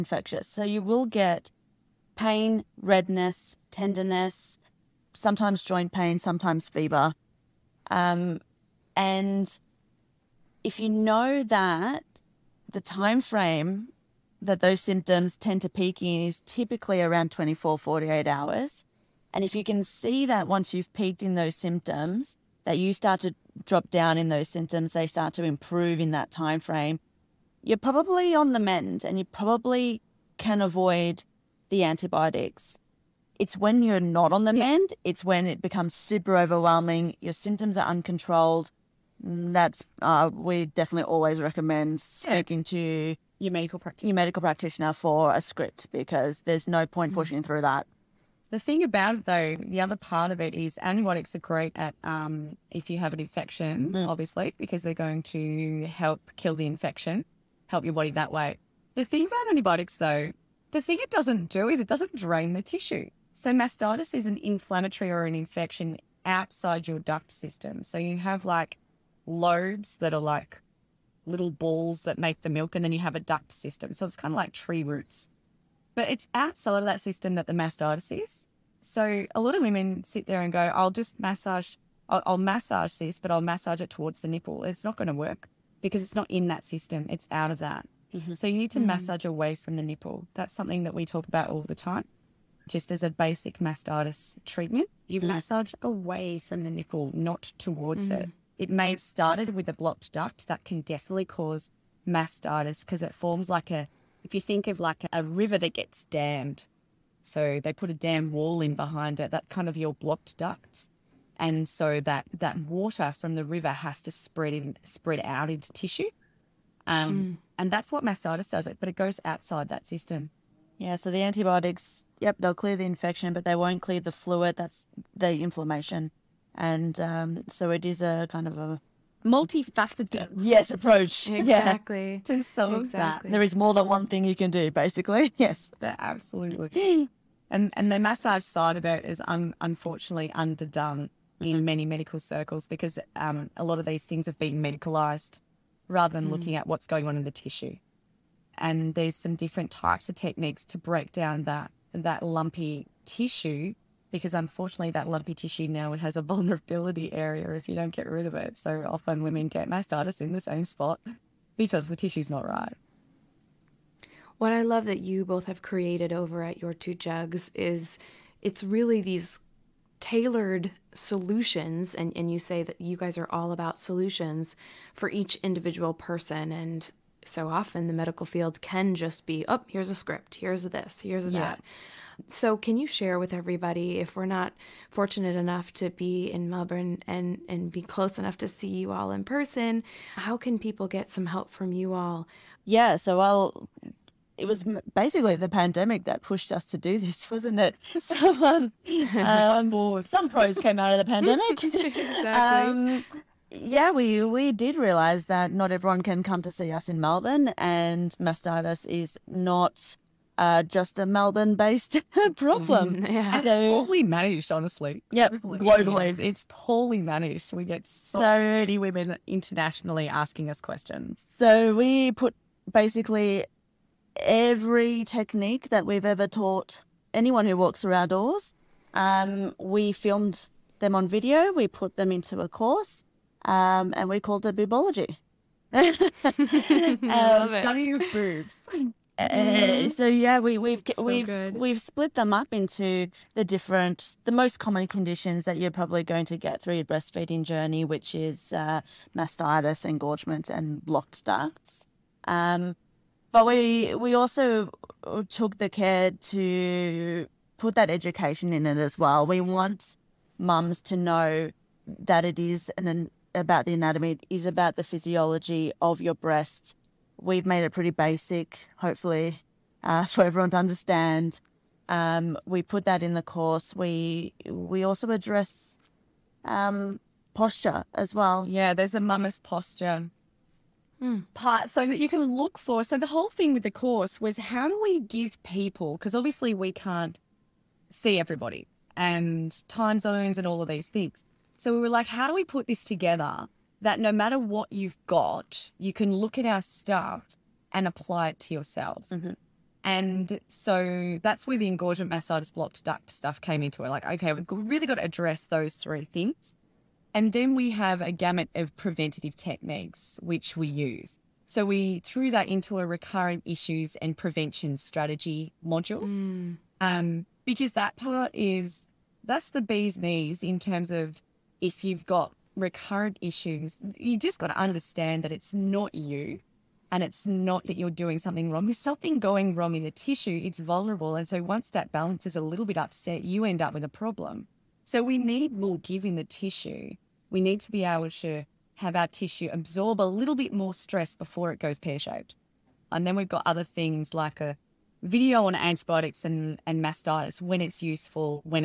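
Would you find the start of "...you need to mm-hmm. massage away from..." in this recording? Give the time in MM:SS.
01:28.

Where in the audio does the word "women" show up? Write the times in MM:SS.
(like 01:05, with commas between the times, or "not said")
01:19, 02:39, 03:38.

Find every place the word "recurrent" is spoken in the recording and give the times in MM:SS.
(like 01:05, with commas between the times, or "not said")
05:12, 05:22.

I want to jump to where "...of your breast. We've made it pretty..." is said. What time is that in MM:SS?
04:25.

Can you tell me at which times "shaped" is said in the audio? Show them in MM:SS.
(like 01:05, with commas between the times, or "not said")
05:41.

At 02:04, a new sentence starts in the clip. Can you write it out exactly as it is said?
That's the inflammation, and um, so it is a kind of a multifaceted yes approach.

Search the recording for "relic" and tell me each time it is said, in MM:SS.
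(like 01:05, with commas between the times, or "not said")
not said.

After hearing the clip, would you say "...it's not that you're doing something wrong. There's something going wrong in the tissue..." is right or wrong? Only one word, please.
right.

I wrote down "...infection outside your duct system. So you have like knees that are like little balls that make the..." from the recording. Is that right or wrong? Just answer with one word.
wrong.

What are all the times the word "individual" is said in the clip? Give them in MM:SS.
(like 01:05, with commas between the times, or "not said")
02:55.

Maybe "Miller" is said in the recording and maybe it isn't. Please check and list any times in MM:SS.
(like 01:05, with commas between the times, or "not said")
not said.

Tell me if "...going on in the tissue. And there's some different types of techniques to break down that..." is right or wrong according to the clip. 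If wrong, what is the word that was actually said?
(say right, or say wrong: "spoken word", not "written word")
right.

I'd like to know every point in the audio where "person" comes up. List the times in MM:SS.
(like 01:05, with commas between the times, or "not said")
02:55, 03:09.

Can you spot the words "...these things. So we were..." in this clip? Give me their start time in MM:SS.
04:50.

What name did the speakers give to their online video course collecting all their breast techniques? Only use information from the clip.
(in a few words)
Boobology.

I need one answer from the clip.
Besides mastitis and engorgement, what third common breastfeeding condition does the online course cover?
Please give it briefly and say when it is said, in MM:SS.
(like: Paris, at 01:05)
Blocked ducts, at 04:10.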